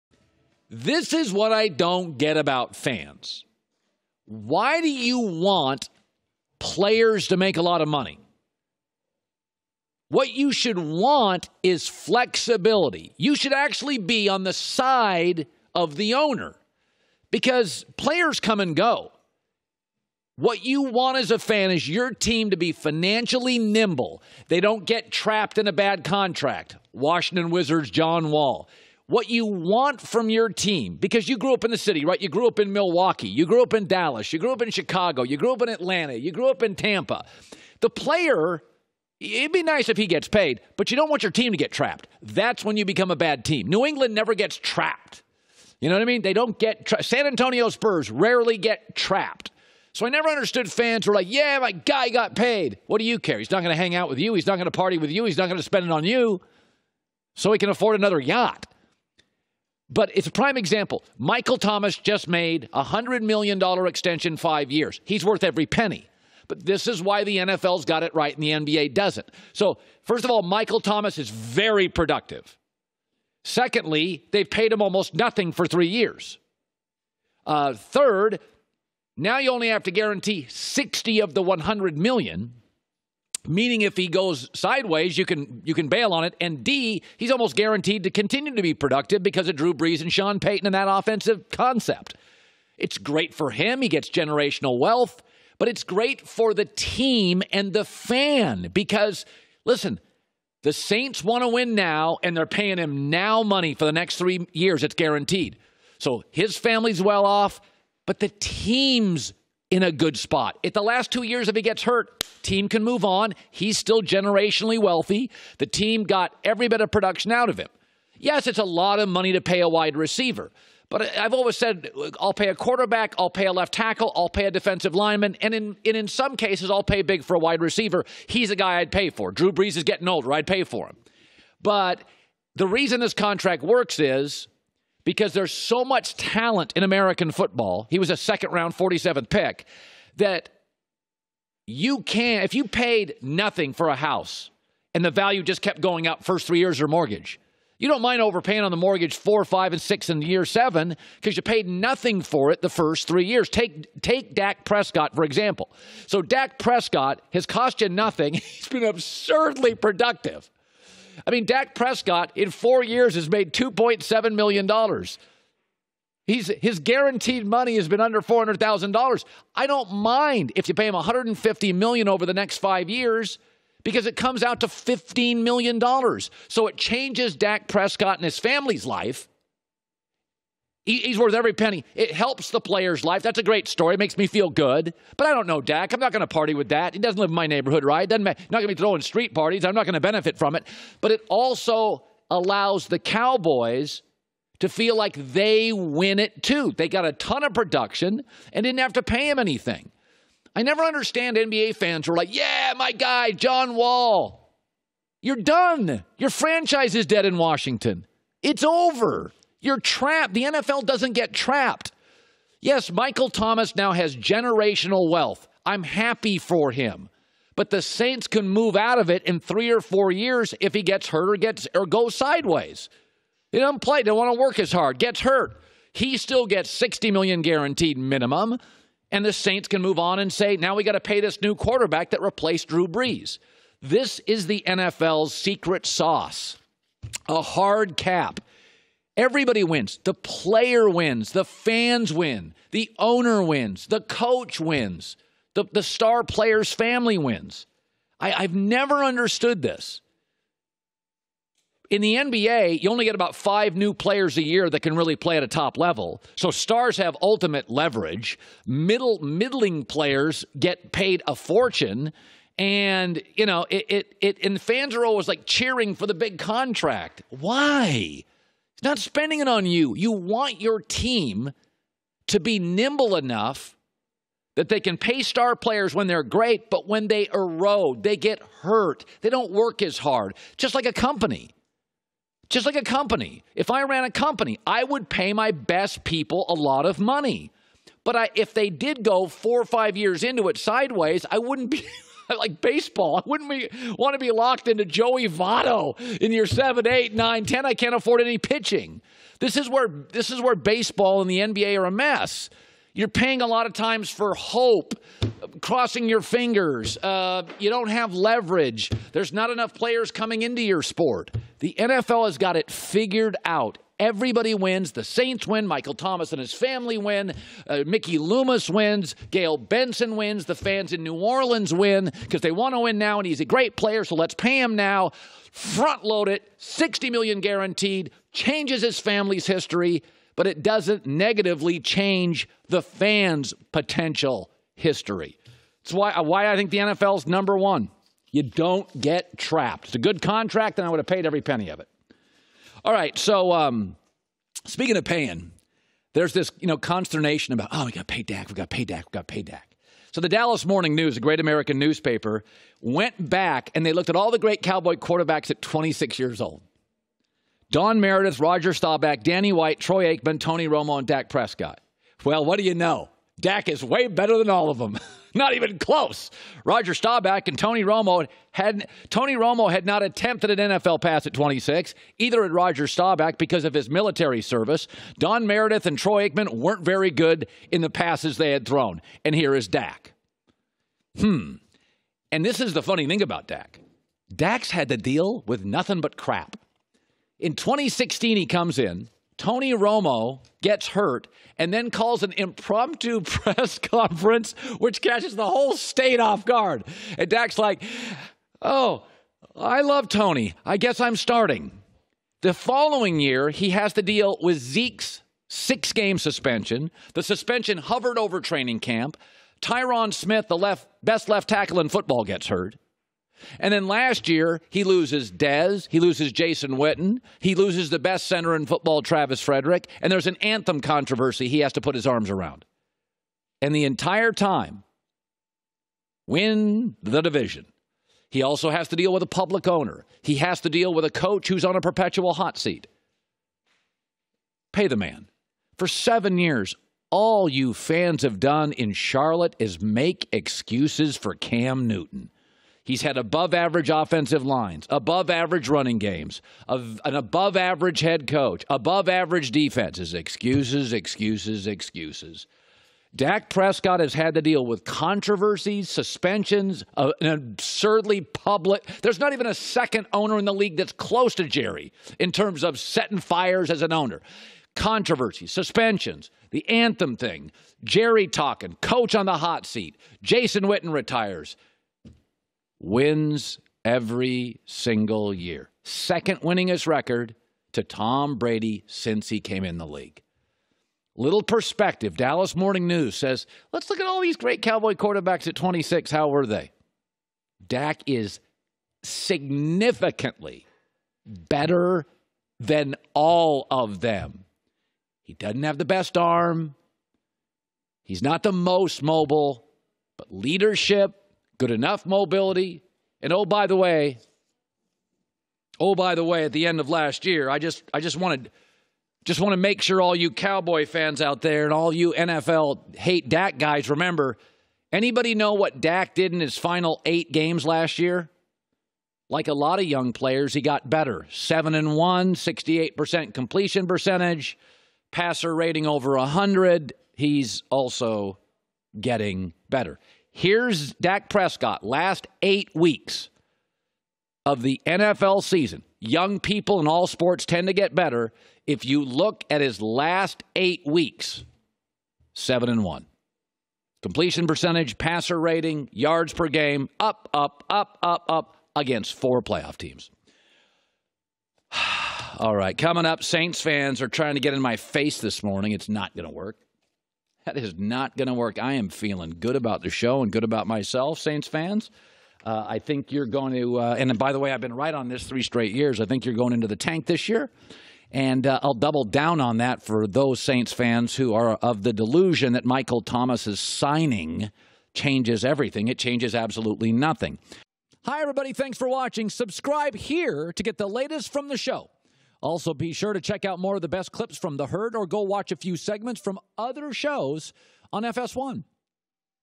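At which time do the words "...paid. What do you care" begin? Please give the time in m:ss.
0:52.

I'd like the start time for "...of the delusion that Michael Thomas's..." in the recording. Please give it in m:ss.
9:31.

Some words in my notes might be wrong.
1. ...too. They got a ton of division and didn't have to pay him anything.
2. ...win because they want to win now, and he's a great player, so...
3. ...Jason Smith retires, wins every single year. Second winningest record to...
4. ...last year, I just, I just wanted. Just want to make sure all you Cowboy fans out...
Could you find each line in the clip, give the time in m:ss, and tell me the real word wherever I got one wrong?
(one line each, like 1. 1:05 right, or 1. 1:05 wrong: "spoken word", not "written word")
1. 3:16 wrong: "production", not "division"
2. 5:21 right
3. 7:50 wrong: "Witten", not "Smith"
4. 8:26 right.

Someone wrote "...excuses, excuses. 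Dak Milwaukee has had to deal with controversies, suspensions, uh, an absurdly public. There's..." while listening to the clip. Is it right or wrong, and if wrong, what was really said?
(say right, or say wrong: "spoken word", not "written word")
wrong: "Prescott", not "Milwaukee".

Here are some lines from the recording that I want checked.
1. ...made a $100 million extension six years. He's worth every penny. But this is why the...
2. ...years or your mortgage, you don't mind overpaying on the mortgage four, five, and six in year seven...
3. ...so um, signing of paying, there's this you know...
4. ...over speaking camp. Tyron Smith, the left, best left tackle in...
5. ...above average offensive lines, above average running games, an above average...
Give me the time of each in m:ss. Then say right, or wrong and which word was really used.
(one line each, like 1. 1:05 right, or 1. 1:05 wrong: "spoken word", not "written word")
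1. 1:02 wrong: "five", not "six"
2. 2:26 right
3. 5:43 wrong: "speaking", not "signing"
4. 6:48 wrong: "training", not "speaking"
5. 7:23 right.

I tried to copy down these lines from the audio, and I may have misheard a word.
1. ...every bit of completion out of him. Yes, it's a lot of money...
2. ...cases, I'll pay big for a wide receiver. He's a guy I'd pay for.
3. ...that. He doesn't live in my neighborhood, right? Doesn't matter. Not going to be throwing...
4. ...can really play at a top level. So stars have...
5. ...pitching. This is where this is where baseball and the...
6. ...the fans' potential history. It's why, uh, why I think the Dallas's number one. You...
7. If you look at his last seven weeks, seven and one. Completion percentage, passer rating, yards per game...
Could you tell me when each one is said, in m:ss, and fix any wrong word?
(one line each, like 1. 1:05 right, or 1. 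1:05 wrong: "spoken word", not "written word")
1. 1:56 wrong: "production", not "completion"
2. 2:06 right
3. 3:06 right
4. 4:14 right
5. 4:58 right
6. 5:32 wrong: "NFL", not "Dallas"
7. 8:58 wrong: "eight", not "seven".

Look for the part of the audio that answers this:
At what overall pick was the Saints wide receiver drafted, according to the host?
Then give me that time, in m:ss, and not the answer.
2:18.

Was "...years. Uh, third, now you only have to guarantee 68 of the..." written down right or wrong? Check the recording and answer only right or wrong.
wrong.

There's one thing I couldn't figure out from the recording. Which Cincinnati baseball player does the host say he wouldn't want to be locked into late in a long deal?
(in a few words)
Joey Votto.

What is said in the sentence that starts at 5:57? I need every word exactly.
Don Meredith, Roger Staubach, Danny White, Troy Aikman, Tony Romo, and Dak Prescott.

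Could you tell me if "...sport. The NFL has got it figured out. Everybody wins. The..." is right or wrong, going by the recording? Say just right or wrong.
right.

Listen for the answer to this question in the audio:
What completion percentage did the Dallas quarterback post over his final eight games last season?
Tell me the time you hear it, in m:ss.
8:42.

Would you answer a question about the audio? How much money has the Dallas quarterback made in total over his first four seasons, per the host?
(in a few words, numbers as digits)
$2.7 million.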